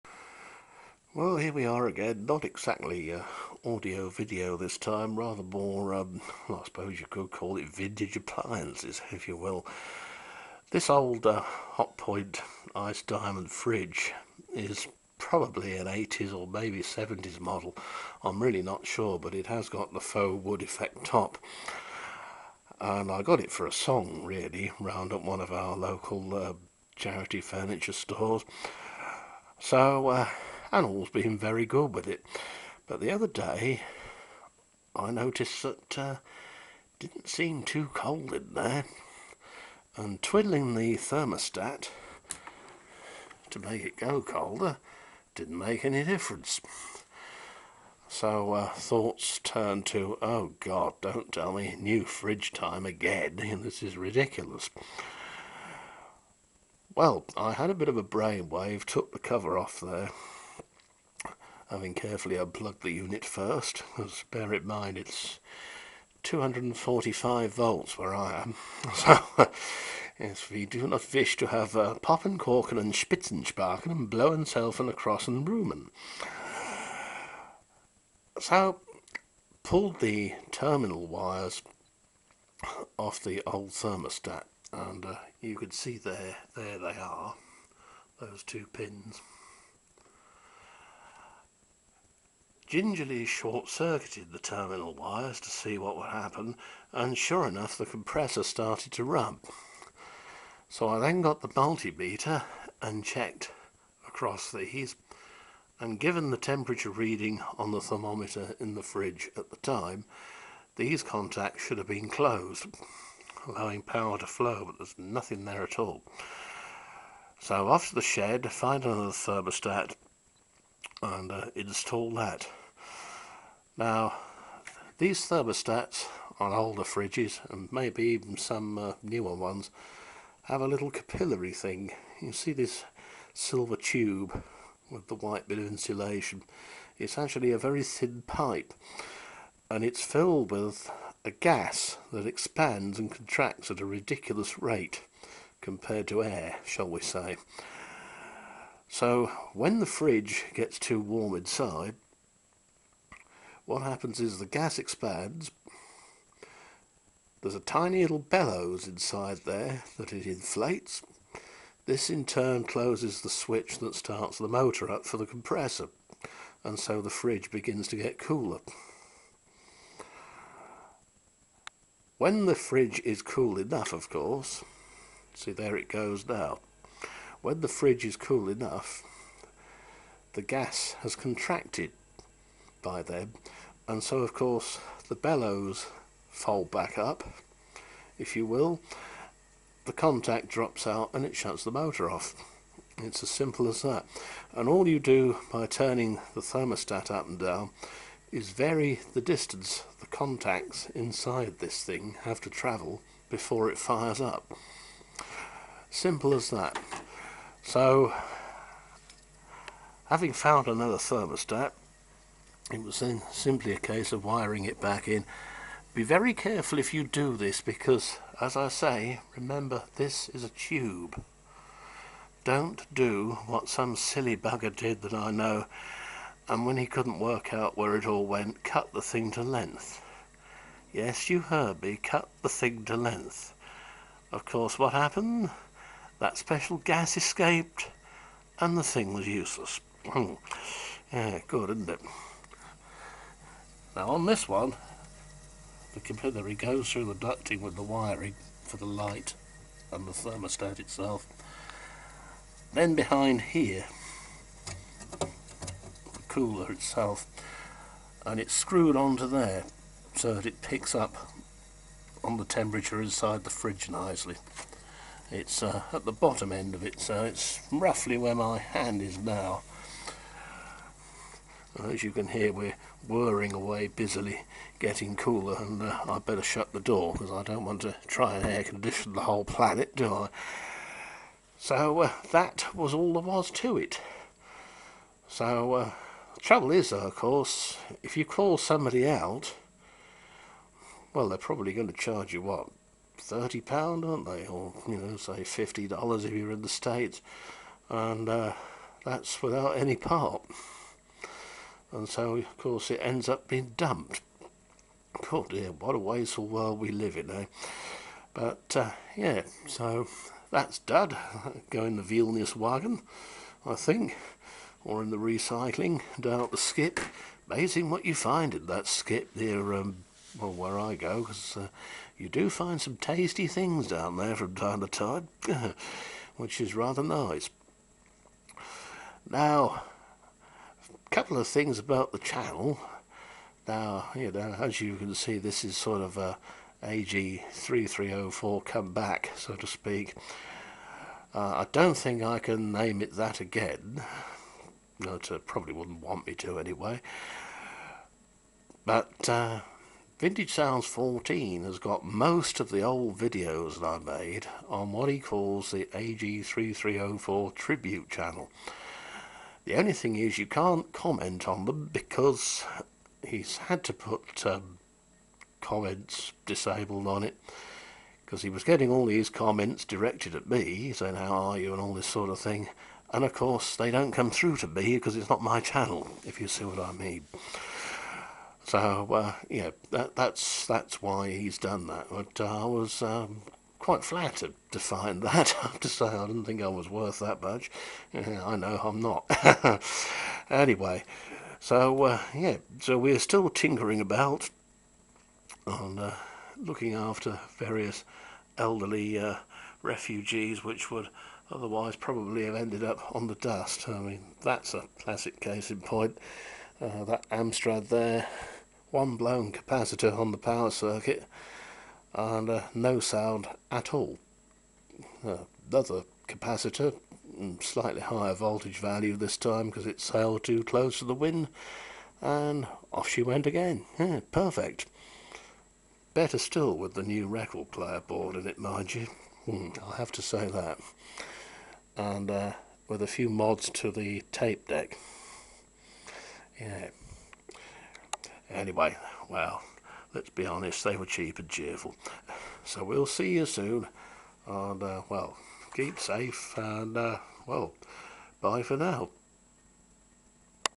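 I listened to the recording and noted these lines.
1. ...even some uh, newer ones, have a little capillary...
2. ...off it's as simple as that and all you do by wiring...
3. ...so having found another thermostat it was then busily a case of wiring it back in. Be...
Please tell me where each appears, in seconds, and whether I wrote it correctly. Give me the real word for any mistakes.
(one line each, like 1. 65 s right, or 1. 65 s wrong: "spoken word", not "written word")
1. 128 s right
2. 192 s wrong: "turning", not "wiring"
3. 207 s wrong: "simply", not "busily".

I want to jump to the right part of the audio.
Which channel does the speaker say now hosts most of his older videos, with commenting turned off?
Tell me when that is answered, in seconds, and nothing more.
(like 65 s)
350 s.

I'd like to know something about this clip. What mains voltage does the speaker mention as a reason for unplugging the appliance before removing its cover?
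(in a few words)
245 volts.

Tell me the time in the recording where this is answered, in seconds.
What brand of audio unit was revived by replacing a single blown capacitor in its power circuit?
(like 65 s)
407 s.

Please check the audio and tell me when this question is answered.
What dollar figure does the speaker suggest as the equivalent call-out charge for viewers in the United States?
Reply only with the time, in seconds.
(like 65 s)
295 s.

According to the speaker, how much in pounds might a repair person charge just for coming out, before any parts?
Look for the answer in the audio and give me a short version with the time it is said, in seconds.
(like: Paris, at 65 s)
30 pounds, at 293 s.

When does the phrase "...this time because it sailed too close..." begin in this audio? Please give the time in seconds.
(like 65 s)
419 s.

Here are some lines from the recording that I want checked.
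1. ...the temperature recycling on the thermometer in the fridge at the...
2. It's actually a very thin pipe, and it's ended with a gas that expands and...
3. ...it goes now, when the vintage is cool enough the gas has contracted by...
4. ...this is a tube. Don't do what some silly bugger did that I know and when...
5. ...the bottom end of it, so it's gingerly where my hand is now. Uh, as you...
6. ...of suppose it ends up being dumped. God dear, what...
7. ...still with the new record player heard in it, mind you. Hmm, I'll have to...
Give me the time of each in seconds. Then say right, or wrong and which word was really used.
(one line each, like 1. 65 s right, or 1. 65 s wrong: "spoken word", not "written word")
1. 106 s wrong: "reading", not "recycling"
2. 136 s wrong: "filled", not "ended"
3. 175 s wrong: "fridge", not "vintage"
4. 219 s right
5. 266 s wrong: "roughly", not "gingerly"
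6. 302 s wrong: "course", not "suppose"
7. 426 s wrong: "board", not "heard".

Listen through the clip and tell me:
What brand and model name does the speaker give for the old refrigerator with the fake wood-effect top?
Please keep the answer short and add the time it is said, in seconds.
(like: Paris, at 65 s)
Hot Point Ice Diamond, at 11 s.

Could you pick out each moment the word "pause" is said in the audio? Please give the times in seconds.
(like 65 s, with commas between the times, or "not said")
not said.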